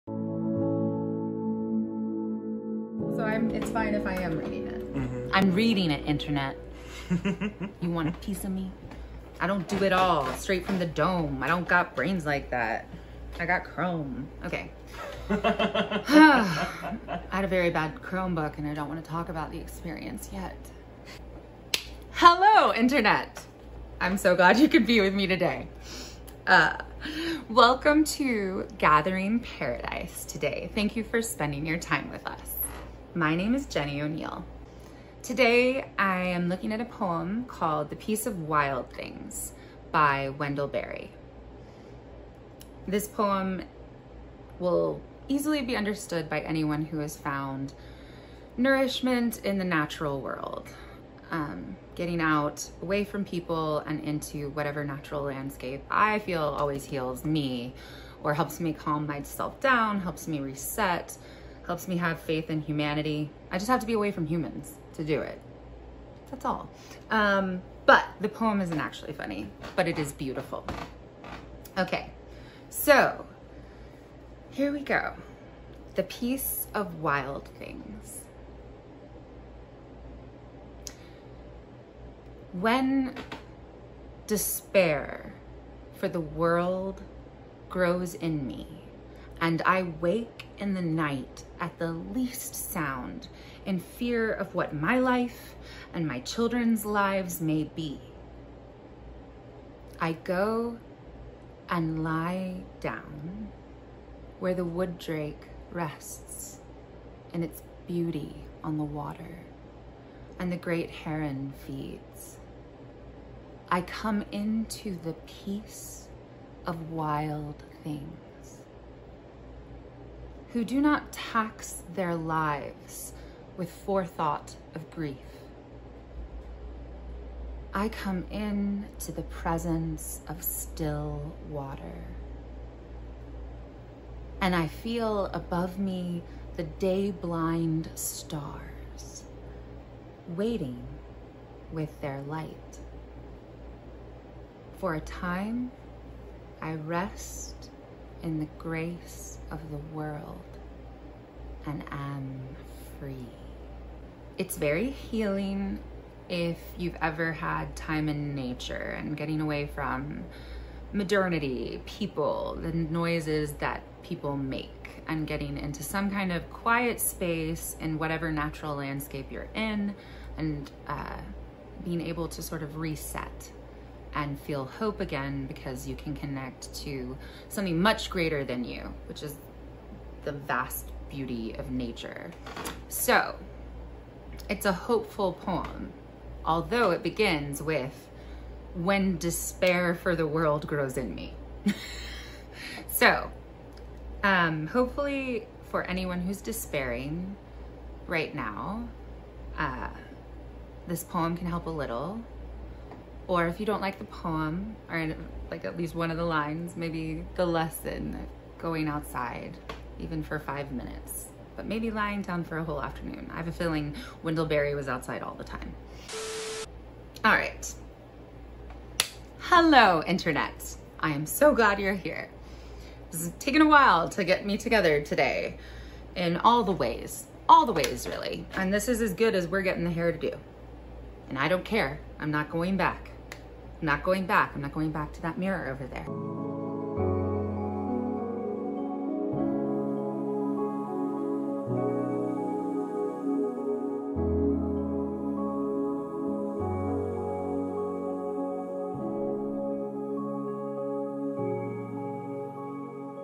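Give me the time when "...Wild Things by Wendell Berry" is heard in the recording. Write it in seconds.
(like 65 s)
38 s.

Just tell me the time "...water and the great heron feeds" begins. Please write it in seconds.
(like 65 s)
108 s.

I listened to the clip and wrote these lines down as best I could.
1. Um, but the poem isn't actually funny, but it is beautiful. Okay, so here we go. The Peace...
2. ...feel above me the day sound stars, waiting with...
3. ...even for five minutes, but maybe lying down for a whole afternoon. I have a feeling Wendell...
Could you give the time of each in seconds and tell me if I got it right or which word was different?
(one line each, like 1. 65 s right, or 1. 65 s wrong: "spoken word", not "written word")
1. 67 s right
2. 134 s wrong: "blind", not "sound"
3. 209 s right.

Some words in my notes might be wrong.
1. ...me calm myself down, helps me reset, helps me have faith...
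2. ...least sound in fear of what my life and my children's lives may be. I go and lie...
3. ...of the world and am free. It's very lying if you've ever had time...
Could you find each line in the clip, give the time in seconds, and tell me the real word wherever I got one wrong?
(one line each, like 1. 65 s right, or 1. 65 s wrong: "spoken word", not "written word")
1. 58 s right
2. 91 s right
3. 149 s wrong: "healing", not "lying".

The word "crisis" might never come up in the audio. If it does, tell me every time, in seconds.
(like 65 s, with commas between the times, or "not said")
not said.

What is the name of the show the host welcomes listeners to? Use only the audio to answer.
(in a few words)
Gathering Paradise.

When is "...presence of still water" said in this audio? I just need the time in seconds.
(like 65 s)
129 s.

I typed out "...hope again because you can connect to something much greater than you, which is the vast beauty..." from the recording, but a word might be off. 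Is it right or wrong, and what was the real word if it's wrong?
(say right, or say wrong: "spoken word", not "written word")
right.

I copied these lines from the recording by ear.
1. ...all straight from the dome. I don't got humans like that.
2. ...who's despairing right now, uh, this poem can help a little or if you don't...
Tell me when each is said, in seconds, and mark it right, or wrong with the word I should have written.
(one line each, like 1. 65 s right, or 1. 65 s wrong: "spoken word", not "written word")
1. 10 s wrong: "brains", not "humans"
2. 196 s right.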